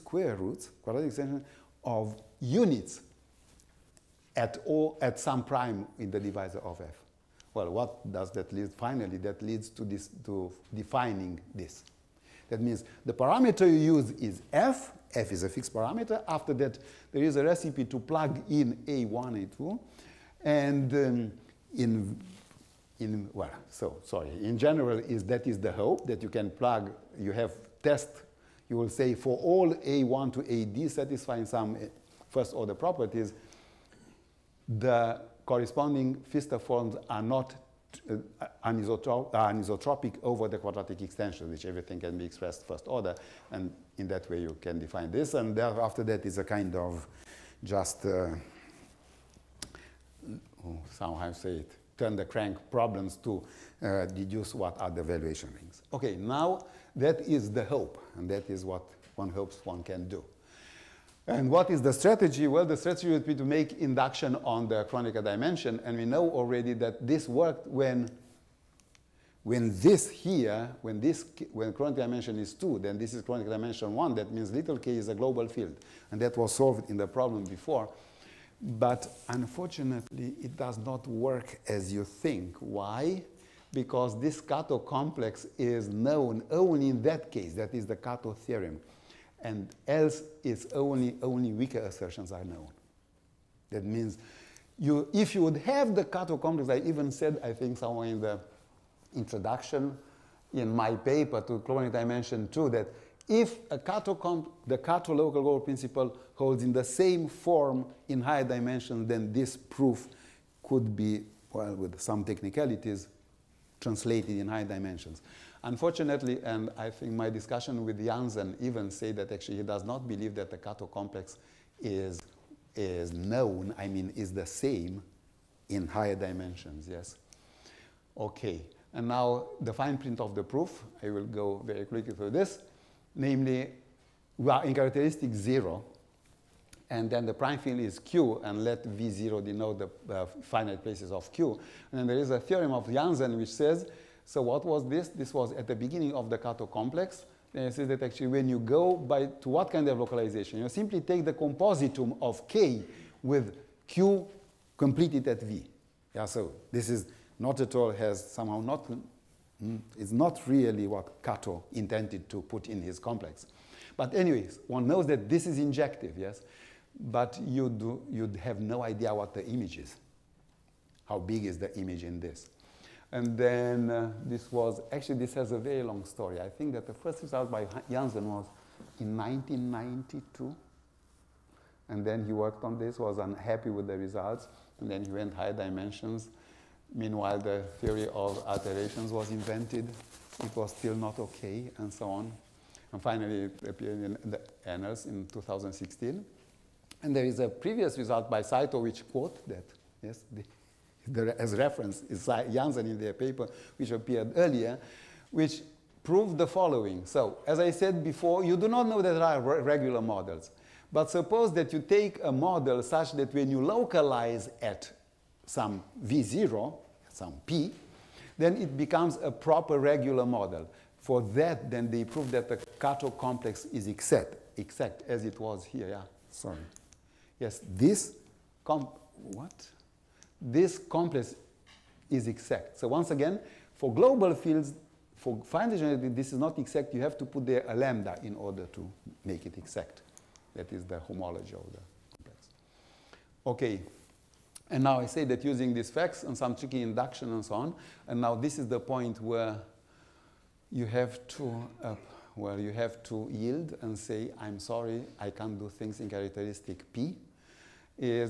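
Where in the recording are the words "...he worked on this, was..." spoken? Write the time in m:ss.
3:02.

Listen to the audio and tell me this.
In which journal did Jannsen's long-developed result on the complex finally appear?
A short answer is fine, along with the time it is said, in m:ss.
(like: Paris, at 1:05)
the Annals, at 3:14.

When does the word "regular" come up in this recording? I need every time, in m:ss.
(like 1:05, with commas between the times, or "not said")
3:29, 3:39.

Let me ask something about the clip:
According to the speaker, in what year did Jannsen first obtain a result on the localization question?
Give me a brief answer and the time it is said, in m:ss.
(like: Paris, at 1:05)
1992, at 2:59.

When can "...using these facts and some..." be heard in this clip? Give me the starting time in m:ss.
4:05.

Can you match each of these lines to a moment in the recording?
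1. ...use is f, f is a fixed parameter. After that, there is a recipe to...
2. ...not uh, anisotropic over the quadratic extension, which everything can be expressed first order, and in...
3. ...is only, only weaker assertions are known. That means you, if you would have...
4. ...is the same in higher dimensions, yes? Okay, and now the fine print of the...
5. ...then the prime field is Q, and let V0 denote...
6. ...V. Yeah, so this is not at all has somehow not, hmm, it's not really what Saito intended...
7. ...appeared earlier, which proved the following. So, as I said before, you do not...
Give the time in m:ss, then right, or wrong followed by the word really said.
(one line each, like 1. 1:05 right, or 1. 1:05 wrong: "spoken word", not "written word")
1. 0:13 right
2. 0:37 right
3. 1:30 right
4. 2:04 right
5. 2:17 right
6. 2:35 wrong: "Kato", not "Saito"
7. 3:23 right.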